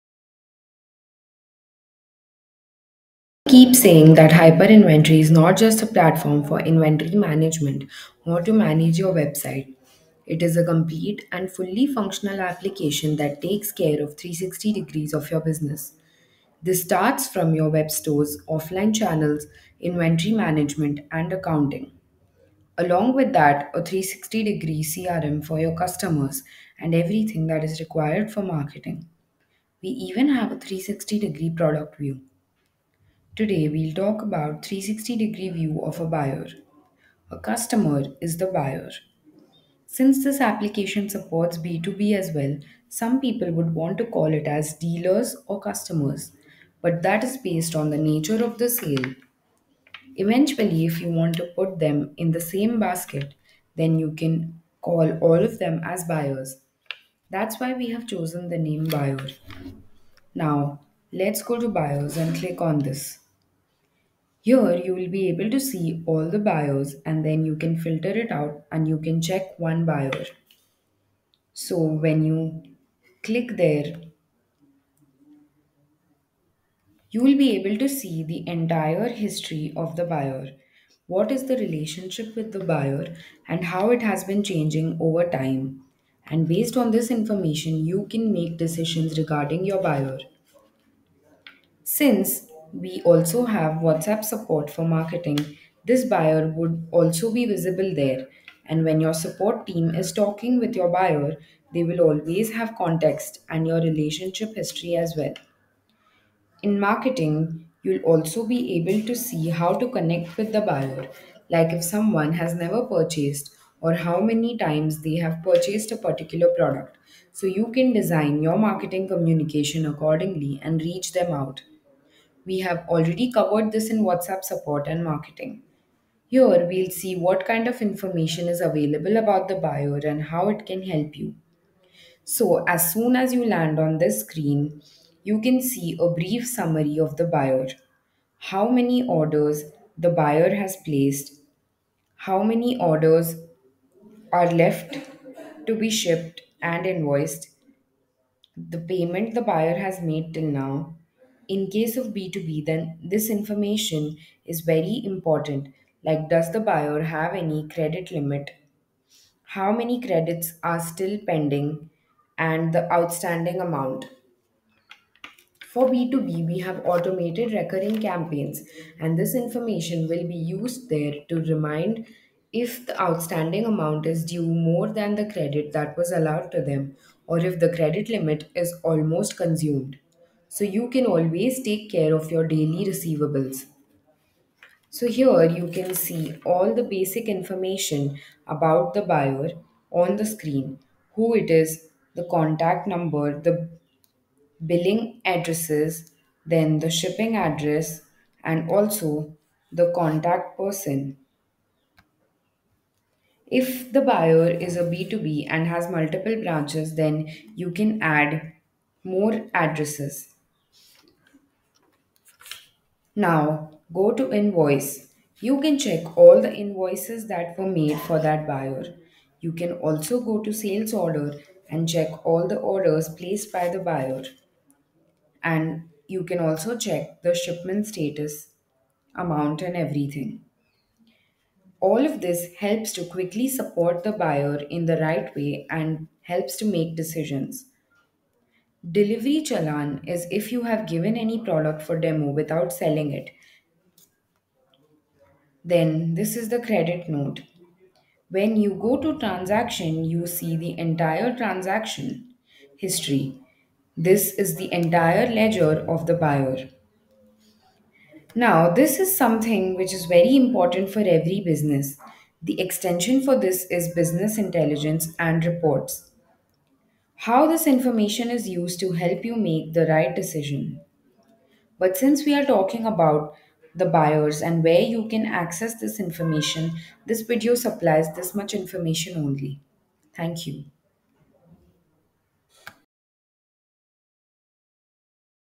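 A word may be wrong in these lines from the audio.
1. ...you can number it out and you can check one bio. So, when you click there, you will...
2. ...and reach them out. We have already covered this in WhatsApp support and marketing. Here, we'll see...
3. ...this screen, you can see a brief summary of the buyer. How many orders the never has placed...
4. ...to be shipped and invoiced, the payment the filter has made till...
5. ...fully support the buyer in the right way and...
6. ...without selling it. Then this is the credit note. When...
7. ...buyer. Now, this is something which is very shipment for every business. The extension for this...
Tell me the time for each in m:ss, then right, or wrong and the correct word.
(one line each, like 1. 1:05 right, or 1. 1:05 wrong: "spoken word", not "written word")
1. 1:07 wrong: "filter", not "number"
2. 2:00 right
3. 2:13 wrong: "buyer", not "never"
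4. 2:25 wrong: "buyer", not "filter"
5. 3:53 wrong: "quickly", not "fully"
6. 4:02 right
7. 4:16 wrong: "important", not "shipment".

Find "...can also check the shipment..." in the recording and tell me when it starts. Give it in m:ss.
3:46.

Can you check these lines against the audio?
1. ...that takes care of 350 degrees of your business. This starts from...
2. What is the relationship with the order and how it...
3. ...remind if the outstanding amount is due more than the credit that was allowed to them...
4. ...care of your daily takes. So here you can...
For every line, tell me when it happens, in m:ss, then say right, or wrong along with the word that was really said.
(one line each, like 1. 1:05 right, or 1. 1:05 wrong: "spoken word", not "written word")
1. 0:13 wrong: "360", not "350"
2. 1:21 wrong: "buyer", not "order"
3. 2:51 right
4. 3:01 wrong: "receivables", not "takes".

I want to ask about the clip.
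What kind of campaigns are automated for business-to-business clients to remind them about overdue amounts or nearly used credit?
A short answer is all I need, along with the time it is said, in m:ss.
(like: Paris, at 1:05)
recurring campaigns, at 2:46.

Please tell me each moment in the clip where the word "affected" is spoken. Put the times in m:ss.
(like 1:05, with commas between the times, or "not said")
not said.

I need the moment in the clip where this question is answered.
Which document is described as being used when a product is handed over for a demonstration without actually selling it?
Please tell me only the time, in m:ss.
3:58.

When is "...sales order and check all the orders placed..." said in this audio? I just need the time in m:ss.
3:40.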